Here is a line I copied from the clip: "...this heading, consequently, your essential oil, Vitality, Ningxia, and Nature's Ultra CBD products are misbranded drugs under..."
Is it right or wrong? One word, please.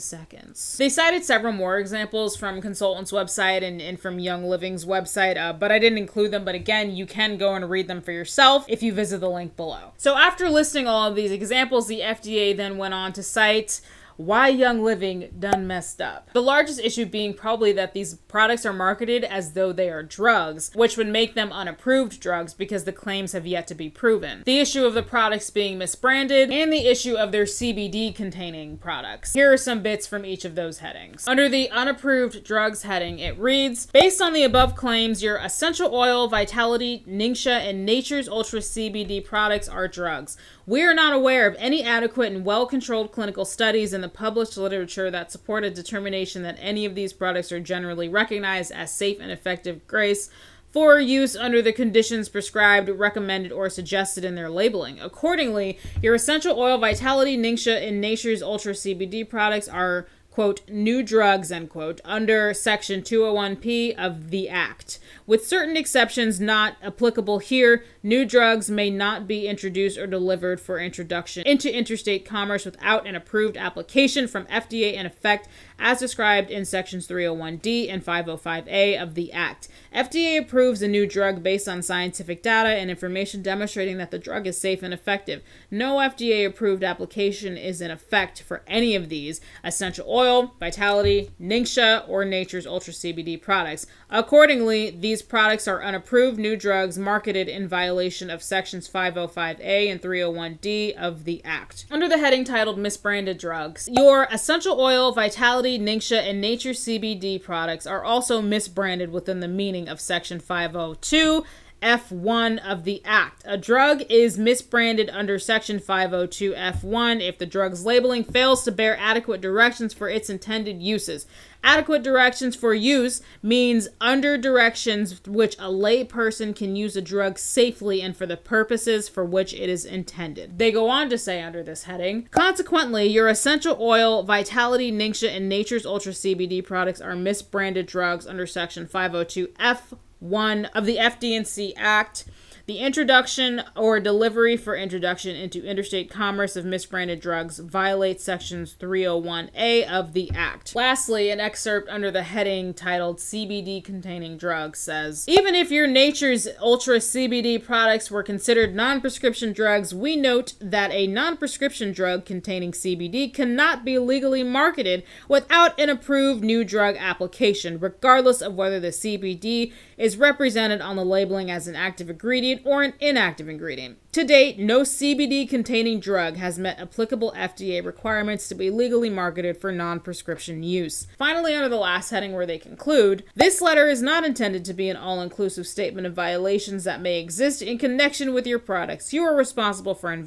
right.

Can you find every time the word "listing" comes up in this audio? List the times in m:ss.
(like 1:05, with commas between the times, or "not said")
0:10.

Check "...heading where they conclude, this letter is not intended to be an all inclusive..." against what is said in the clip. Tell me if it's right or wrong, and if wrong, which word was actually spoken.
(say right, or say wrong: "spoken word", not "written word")
right.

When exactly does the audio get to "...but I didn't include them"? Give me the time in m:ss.
0:05.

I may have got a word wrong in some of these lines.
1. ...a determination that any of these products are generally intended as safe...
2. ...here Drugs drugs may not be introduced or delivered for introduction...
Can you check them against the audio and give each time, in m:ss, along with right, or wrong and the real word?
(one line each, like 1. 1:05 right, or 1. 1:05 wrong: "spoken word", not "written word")
1. 0:45 wrong: "recognized", not "intended"
2. 1:07 wrong: "New", not "Drugs".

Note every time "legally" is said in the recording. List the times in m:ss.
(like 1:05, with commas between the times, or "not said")
2:43, 2:58.